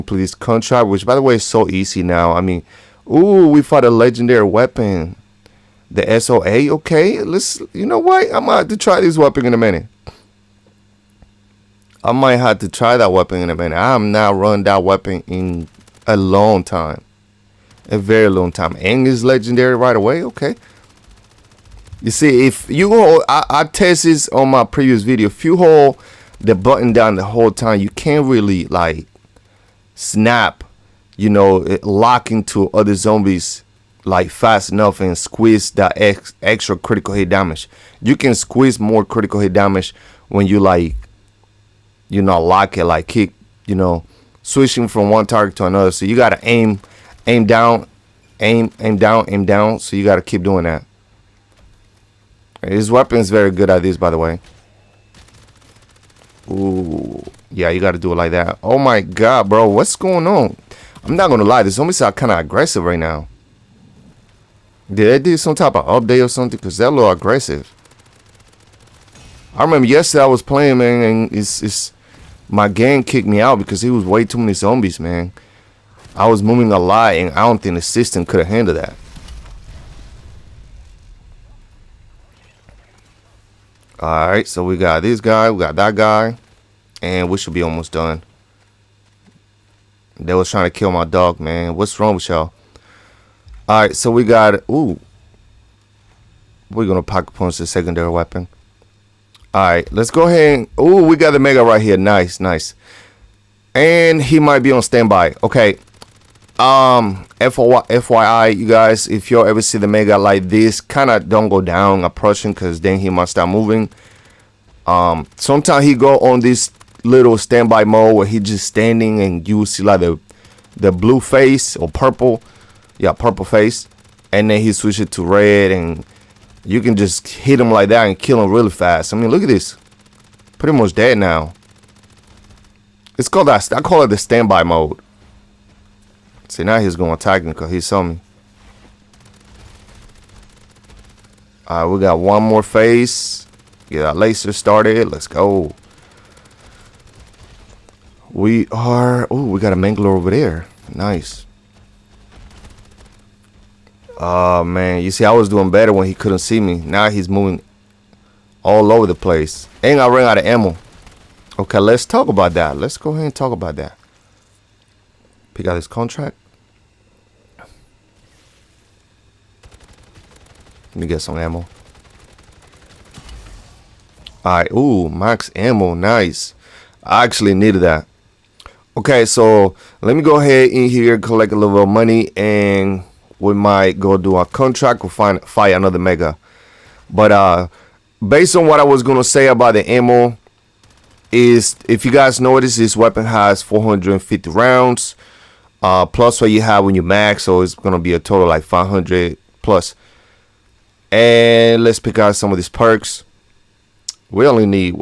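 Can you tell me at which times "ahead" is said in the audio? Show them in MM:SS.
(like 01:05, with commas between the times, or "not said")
01:40, 02:43, 03:00.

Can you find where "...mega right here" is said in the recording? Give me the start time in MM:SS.
01:41.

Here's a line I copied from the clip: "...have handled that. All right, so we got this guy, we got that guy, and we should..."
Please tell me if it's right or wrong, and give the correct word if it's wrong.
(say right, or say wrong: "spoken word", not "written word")
right.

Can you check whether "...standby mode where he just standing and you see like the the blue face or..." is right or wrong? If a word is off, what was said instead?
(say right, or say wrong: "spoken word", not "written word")
right.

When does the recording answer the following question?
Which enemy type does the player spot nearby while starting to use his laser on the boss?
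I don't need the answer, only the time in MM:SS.
02:29.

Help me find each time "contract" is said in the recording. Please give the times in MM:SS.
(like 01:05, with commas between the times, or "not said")
00:00, 02:45, 03:04.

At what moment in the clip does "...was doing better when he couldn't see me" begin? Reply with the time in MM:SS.
02:35.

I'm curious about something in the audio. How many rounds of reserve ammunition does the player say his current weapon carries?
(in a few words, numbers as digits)
450.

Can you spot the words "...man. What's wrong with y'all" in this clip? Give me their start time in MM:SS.
01:31.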